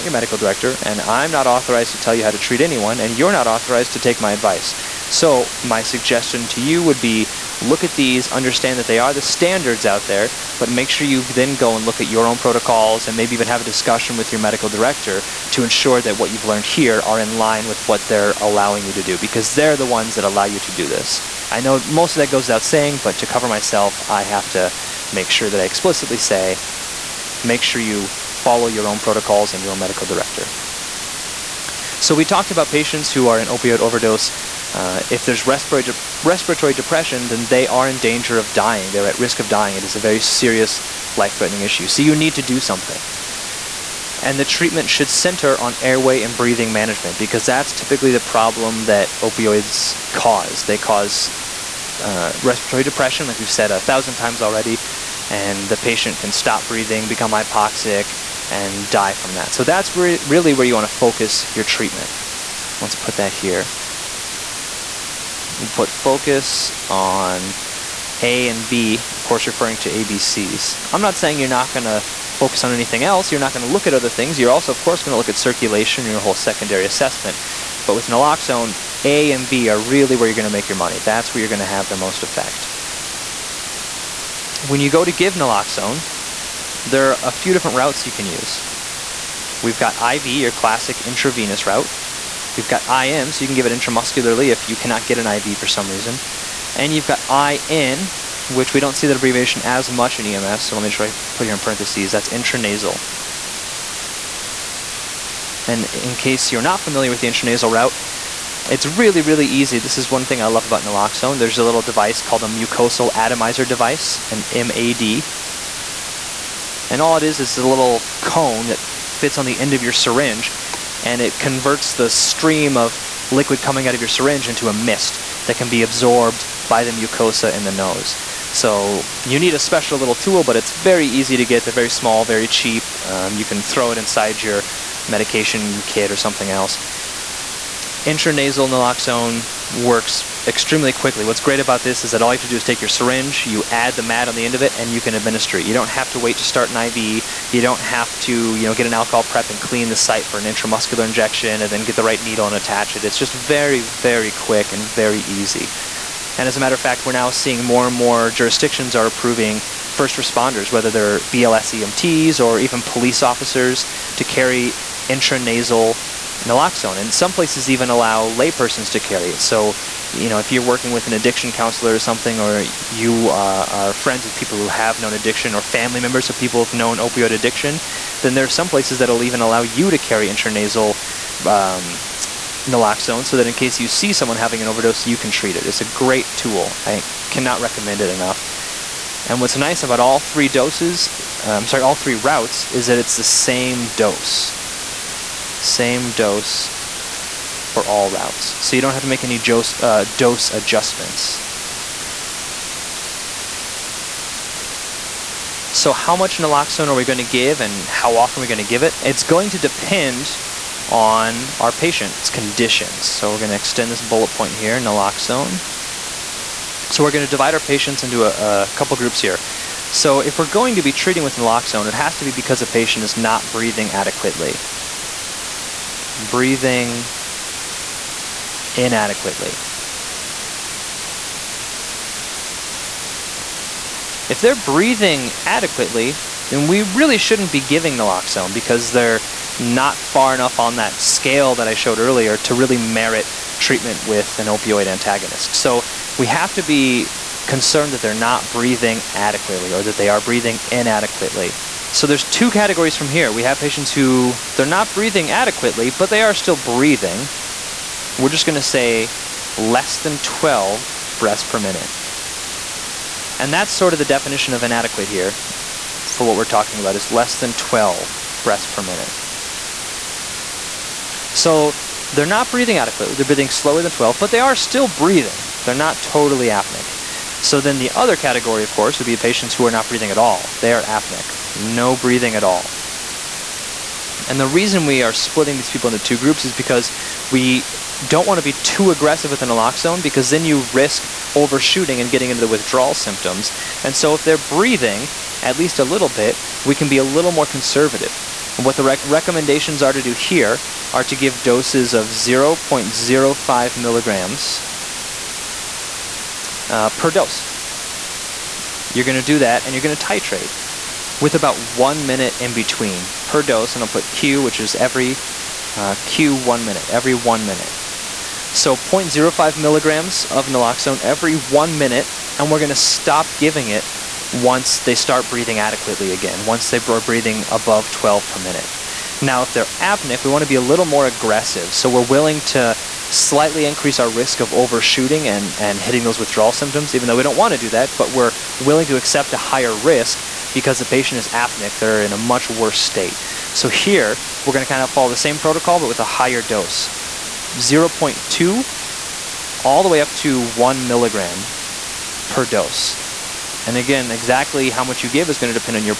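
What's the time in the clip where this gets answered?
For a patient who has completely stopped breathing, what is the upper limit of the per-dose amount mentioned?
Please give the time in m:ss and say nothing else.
5:50.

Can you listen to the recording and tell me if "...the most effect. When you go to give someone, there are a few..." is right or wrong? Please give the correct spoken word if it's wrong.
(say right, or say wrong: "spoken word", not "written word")
wrong: "naloxone", not "someone".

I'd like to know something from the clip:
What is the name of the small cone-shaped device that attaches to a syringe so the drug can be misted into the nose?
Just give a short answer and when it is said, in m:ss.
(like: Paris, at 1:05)
mucosal atomizer device, at 1:52.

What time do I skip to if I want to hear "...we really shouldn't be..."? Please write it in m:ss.
3:56.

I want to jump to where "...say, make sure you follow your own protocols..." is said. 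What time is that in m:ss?
0:26.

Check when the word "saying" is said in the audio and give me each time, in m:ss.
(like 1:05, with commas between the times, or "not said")
0:22, 1:11.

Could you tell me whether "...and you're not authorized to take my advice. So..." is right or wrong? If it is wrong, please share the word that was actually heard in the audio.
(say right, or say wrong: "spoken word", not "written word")
right.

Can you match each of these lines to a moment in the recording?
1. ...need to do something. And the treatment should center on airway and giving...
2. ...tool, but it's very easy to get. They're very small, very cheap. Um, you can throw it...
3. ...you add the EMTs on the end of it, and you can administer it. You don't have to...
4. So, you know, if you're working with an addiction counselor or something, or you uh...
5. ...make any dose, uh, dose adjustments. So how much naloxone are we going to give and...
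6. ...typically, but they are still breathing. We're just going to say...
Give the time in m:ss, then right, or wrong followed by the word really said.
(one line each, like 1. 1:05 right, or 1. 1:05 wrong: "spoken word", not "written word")
1. 0:42 wrong: "breathing", not "giving"
2. 2:10 right
3. 2:23 wrong: "MAD", not "EMTs"
4. 2:49 right
5. 3:19 right
6. 4:15 wrong: "adequately", not "typically".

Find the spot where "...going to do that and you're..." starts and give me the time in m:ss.
5:09.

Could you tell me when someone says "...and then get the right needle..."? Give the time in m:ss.
2:31.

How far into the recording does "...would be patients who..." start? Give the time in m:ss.
4:38.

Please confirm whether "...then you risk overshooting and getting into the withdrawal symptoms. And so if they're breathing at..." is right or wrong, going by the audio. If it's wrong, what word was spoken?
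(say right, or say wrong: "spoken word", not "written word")
right.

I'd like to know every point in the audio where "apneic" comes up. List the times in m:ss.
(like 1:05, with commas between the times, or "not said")
4:36, 4:40, 5:29, 5:41.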